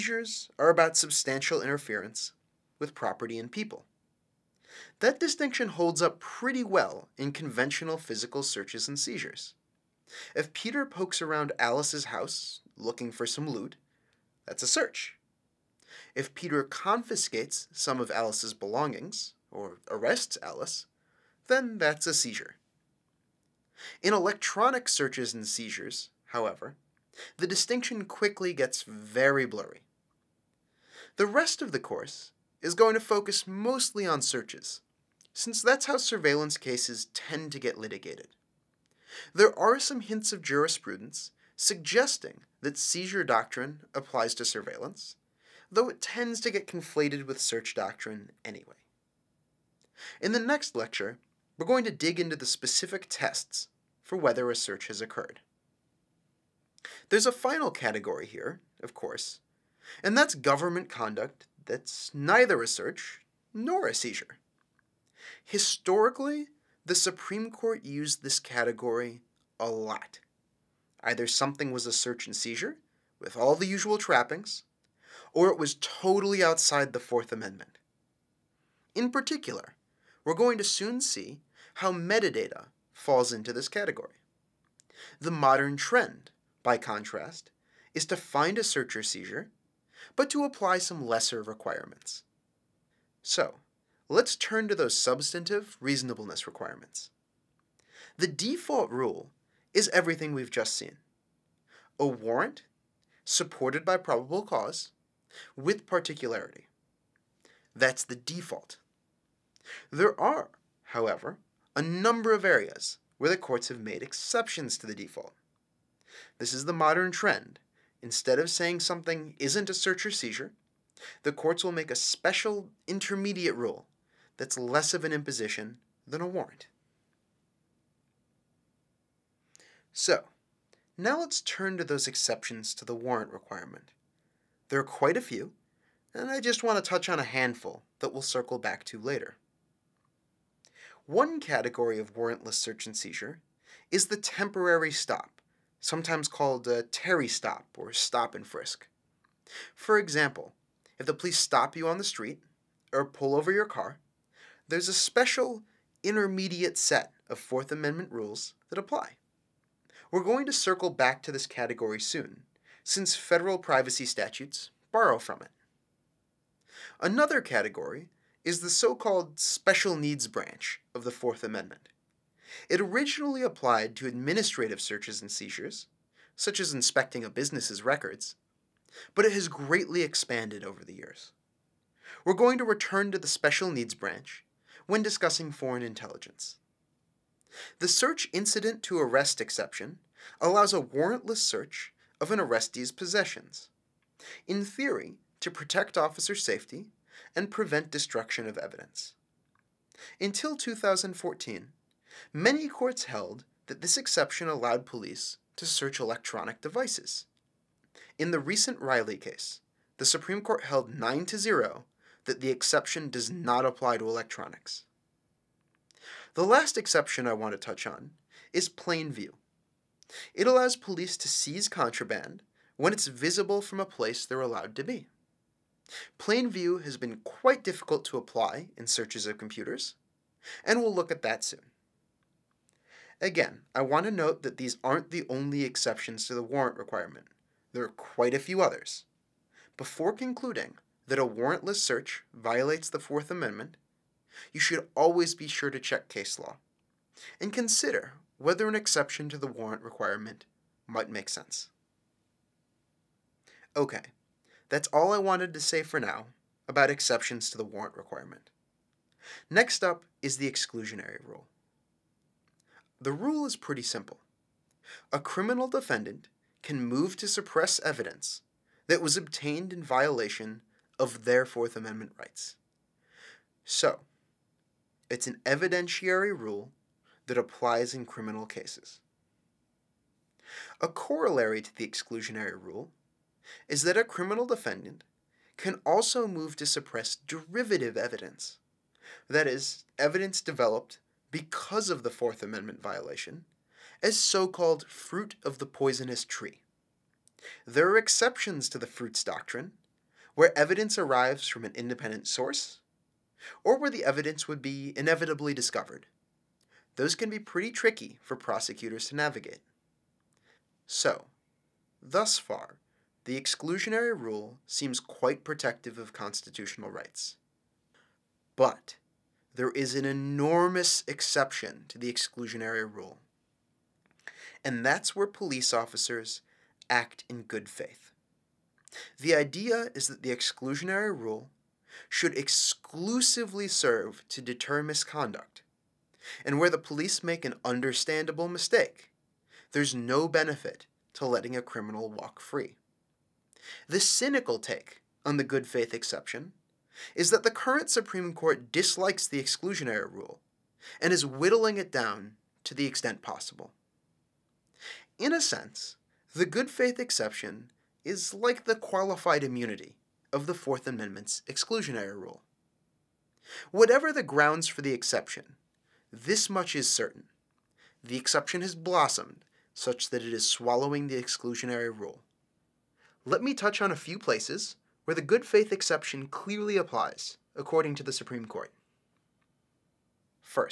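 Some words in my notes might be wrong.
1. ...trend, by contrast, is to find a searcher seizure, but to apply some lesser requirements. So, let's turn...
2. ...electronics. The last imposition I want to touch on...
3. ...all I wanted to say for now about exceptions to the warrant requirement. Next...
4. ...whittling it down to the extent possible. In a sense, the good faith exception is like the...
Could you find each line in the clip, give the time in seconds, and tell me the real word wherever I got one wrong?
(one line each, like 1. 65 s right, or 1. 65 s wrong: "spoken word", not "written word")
1. 85 s right
2. 214 s wrong: "exception", not "imposition"
3. 254 s right
4. 351 s right.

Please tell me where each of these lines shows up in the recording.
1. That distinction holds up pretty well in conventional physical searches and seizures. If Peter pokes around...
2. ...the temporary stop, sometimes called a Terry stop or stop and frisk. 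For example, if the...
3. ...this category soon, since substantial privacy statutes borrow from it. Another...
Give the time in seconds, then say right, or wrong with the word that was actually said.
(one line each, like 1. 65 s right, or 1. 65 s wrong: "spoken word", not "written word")
1. 4 s right
2. 144 s right
3. 161 s wrong: "federal", not "substantial".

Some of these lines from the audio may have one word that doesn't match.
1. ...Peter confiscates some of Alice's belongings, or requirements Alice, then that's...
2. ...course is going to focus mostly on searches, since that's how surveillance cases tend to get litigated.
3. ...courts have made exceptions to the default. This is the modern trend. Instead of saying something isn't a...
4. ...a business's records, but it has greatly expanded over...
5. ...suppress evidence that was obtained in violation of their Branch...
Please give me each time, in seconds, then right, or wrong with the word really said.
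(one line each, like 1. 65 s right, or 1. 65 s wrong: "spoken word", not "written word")
1. 16 s wrong: "arrests", not "requirements"
2. 31 s right
3. 113 s right
4. 177 s right
5. 267 s wrong: "Fourth", not "Branch".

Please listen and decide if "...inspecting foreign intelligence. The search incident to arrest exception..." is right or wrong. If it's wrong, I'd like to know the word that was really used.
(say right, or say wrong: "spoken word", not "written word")
wrong: "discussing", not "inspecting".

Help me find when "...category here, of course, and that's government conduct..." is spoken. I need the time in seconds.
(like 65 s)
57 s.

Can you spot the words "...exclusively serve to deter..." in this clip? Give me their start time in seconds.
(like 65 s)
332 s.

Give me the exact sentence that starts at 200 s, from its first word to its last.
Until 2014, many courts held that this exception allowed police to search electronic devices.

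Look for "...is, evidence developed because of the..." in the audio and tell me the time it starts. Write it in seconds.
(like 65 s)
289 s.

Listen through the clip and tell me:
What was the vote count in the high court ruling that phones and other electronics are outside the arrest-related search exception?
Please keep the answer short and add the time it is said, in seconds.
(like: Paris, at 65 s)
9 to 0, at 210 s.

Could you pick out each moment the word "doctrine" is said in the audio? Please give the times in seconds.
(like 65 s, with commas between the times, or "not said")
43 s, 47 s, 299 s.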